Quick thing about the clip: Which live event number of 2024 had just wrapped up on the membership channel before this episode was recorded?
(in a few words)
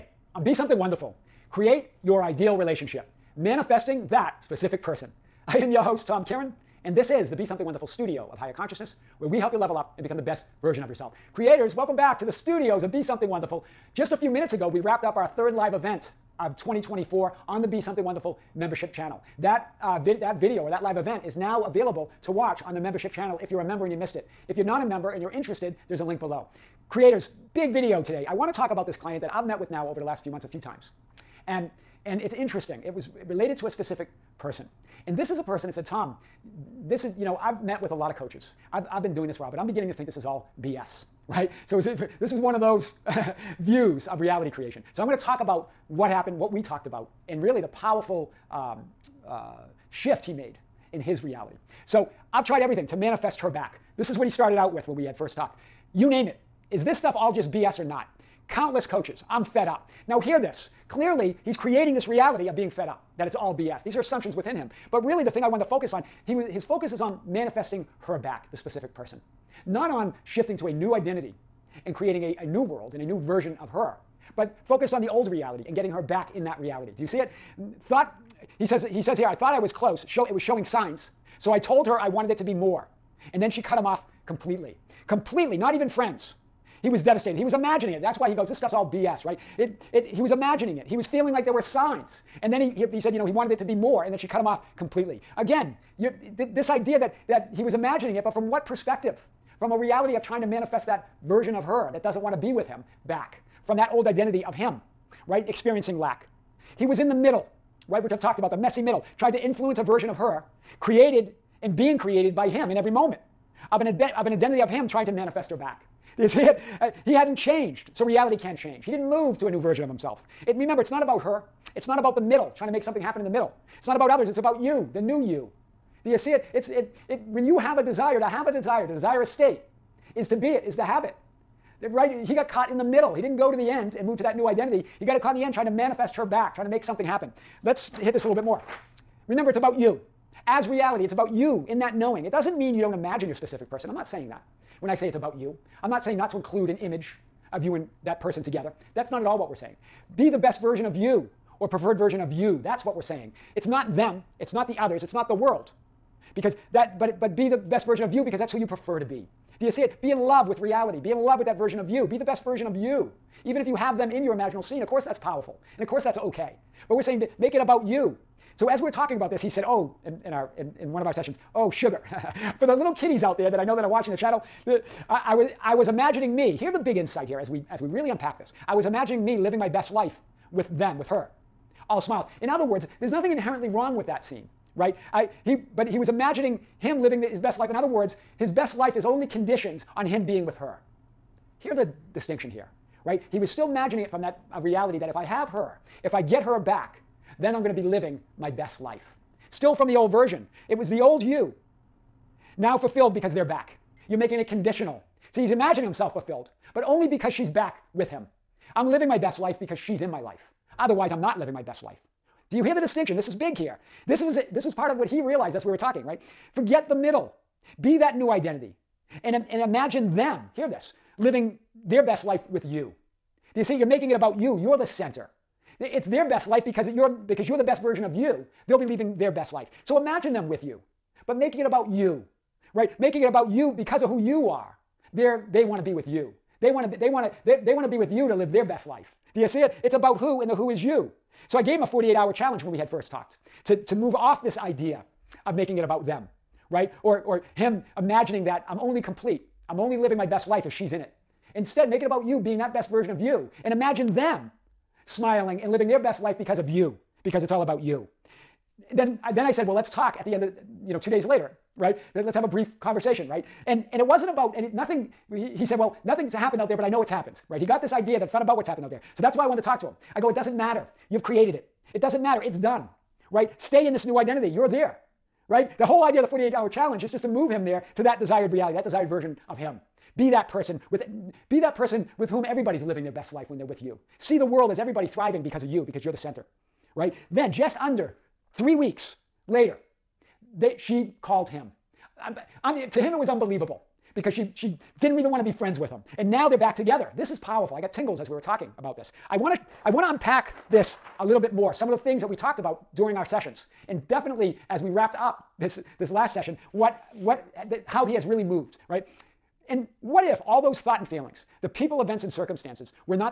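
third.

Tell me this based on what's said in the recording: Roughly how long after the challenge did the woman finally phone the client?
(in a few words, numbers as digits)
just under 3 weeks.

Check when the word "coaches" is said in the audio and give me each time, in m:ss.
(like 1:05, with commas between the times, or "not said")
0:38, 0:58.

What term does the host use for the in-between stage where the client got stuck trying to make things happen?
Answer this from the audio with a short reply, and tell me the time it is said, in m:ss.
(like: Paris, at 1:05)
the messy middle, at 1:48.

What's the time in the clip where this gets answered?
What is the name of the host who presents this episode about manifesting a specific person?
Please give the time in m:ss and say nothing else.
0:06.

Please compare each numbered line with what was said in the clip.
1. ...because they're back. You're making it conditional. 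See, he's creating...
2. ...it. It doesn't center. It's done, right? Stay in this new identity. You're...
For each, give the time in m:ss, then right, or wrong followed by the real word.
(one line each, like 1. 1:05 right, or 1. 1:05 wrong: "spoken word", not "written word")
1. 3:23 wrong: "imagining", not "creating"
2. 4:31 wrong: "matter", not "center".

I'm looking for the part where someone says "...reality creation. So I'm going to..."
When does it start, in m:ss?
0:44.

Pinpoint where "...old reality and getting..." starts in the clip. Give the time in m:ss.
1:15.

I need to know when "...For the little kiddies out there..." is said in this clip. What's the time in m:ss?
2:52.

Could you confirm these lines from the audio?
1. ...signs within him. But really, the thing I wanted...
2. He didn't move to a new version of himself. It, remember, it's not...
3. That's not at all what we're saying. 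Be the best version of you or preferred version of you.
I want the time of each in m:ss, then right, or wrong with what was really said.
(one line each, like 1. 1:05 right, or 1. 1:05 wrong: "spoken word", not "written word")
1. 1:04 wrong: "assumptions", not "signs"
2. 1:58 right
3. 2:28 right.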